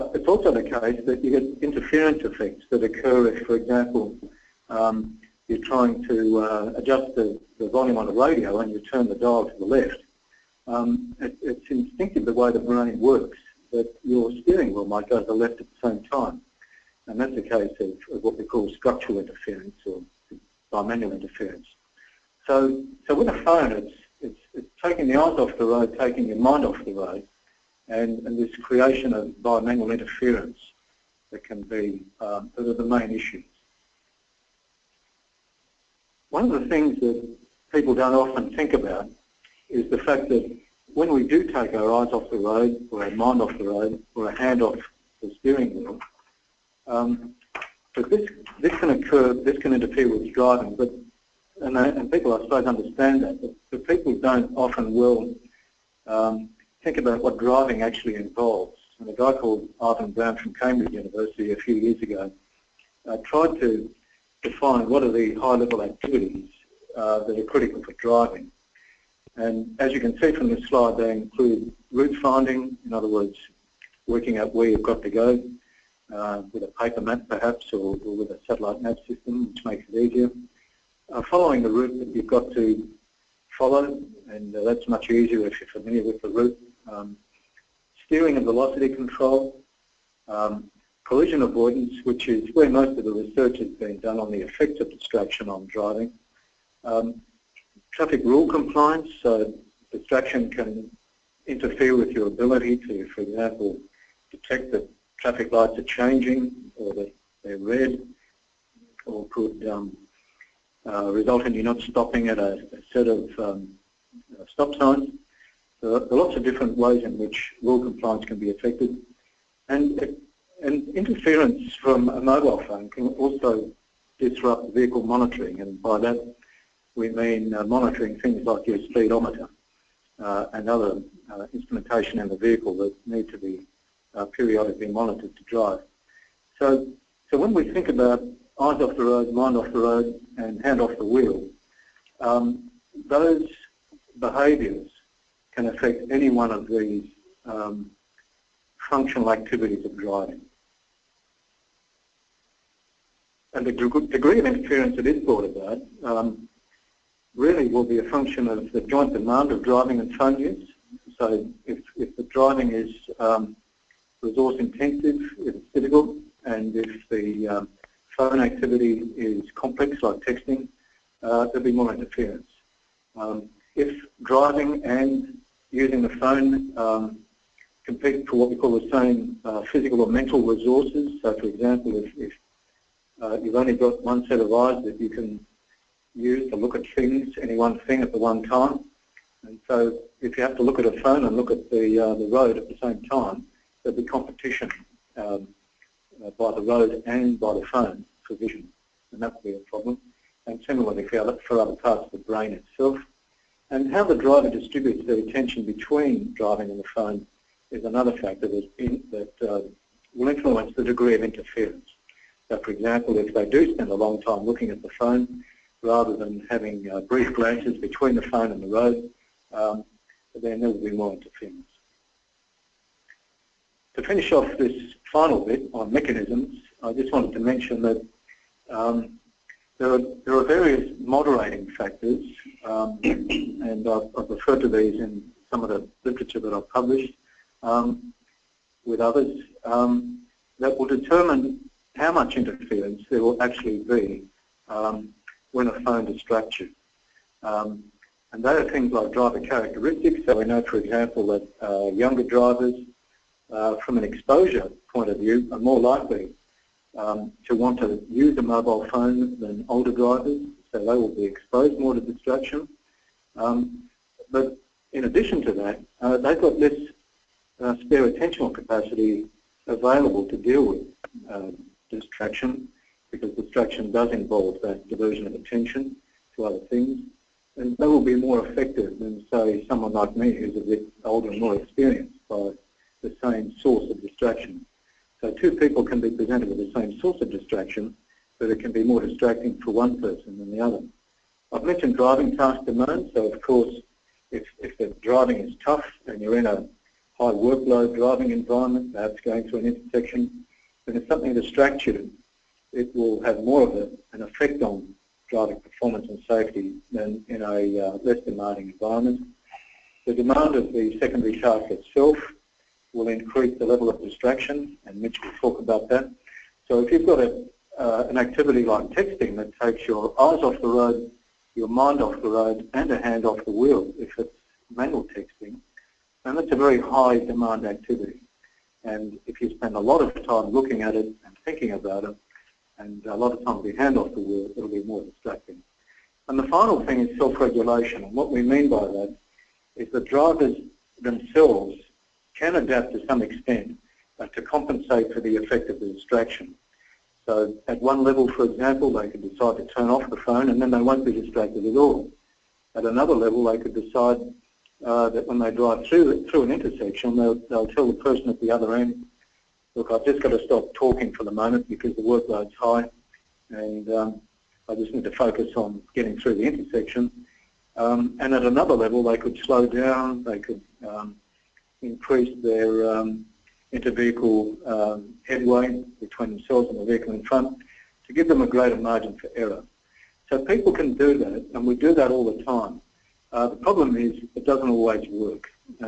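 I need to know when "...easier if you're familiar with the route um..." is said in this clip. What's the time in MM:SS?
01:25.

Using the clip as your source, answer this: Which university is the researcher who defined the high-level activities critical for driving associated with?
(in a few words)
Cambridge University.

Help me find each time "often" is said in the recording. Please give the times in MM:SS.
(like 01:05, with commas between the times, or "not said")
00:38, 00:54.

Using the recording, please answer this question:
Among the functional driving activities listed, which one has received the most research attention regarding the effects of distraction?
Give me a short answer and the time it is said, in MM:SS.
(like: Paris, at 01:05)
collision avoidance, at 01:31.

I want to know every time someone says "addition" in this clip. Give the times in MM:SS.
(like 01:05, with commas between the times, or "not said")
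04:25.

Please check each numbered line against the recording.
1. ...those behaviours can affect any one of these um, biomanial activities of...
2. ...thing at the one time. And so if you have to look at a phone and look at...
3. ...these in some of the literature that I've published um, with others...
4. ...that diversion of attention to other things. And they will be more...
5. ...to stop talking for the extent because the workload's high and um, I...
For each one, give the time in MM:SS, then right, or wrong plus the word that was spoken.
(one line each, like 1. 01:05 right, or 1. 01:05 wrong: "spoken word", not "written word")
1. 02:23 wrong: "functional", not "biomanial"
2. 03:07 right
3. 03:54 right
4. 04:34 right
5. 06:00 wrong: "moment", not "extent".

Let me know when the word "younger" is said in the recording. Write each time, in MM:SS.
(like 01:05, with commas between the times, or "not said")
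04:11.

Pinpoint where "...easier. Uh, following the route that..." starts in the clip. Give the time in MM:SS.
01:19.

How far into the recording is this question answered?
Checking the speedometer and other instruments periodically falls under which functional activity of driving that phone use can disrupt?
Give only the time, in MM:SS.
02:04.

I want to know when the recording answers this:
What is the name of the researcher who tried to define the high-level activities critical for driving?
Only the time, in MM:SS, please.
00:59.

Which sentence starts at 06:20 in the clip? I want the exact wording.
So people can do that, and we do that all the time.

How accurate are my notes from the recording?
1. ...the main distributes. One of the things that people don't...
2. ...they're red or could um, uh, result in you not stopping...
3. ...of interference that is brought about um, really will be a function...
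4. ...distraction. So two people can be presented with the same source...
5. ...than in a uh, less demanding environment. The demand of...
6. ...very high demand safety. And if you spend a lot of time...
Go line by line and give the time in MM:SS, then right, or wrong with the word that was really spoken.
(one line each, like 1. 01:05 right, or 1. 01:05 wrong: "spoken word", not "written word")
1. 00:32 wrong: "issues", not "distributes"
2. 01:47 right
3. 02:34 right
4. 04:44 right
5. 05:06 right
6. 05:26 wrong: "activity", not "safety".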